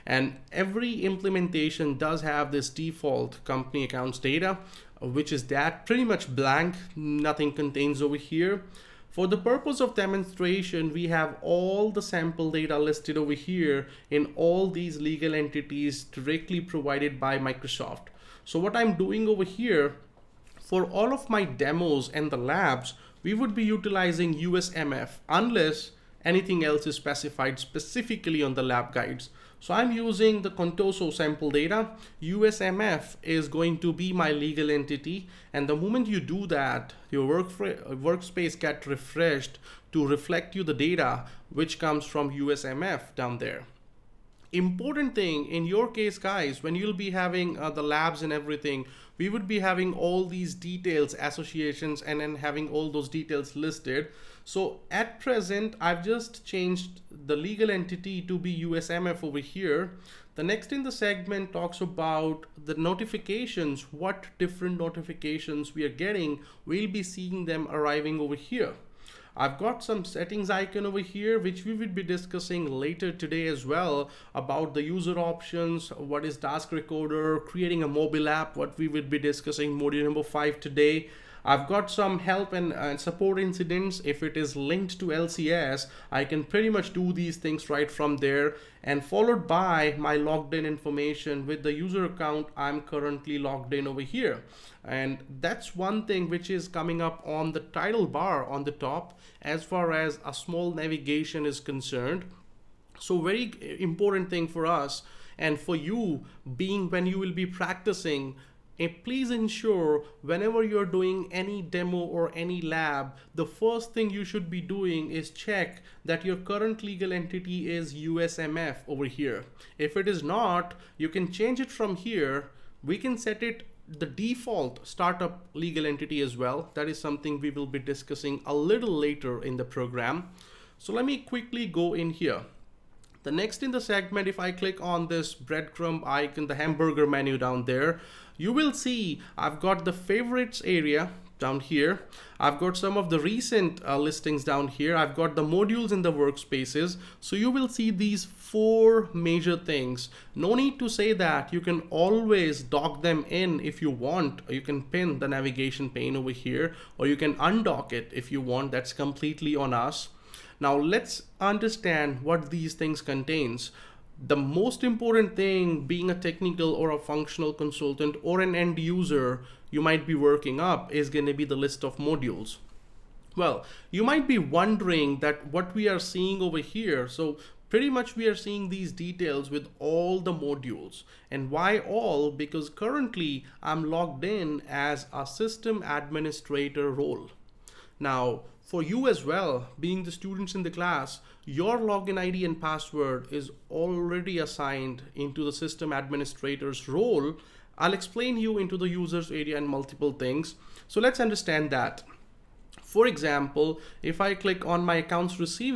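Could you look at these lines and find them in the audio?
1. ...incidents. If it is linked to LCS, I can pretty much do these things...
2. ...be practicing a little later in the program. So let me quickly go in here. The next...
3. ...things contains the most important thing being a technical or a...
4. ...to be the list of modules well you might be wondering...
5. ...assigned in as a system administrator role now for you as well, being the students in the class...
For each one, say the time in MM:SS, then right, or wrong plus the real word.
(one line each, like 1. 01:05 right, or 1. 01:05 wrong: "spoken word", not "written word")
1. 01:23 right
2. 02:07 wrong: "discussing", not "practicing"
3. 02:42 right
4. 02:51 right
5. 03:03 wrong: "logged", not "assigned".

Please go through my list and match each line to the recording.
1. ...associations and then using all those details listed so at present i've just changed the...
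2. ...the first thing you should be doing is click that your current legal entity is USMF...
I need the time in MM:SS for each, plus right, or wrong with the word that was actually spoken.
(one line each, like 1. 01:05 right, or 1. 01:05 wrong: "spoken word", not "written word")
1. 00:51 wrong: "having", not "using"
2. 01:53 wrong: "check", not "click".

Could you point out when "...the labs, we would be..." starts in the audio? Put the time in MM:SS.
00:22.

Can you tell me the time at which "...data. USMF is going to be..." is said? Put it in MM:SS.
00:31.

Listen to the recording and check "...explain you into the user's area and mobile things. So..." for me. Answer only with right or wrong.
wrong.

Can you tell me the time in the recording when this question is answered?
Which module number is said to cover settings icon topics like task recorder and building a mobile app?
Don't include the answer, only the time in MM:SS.
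01:19.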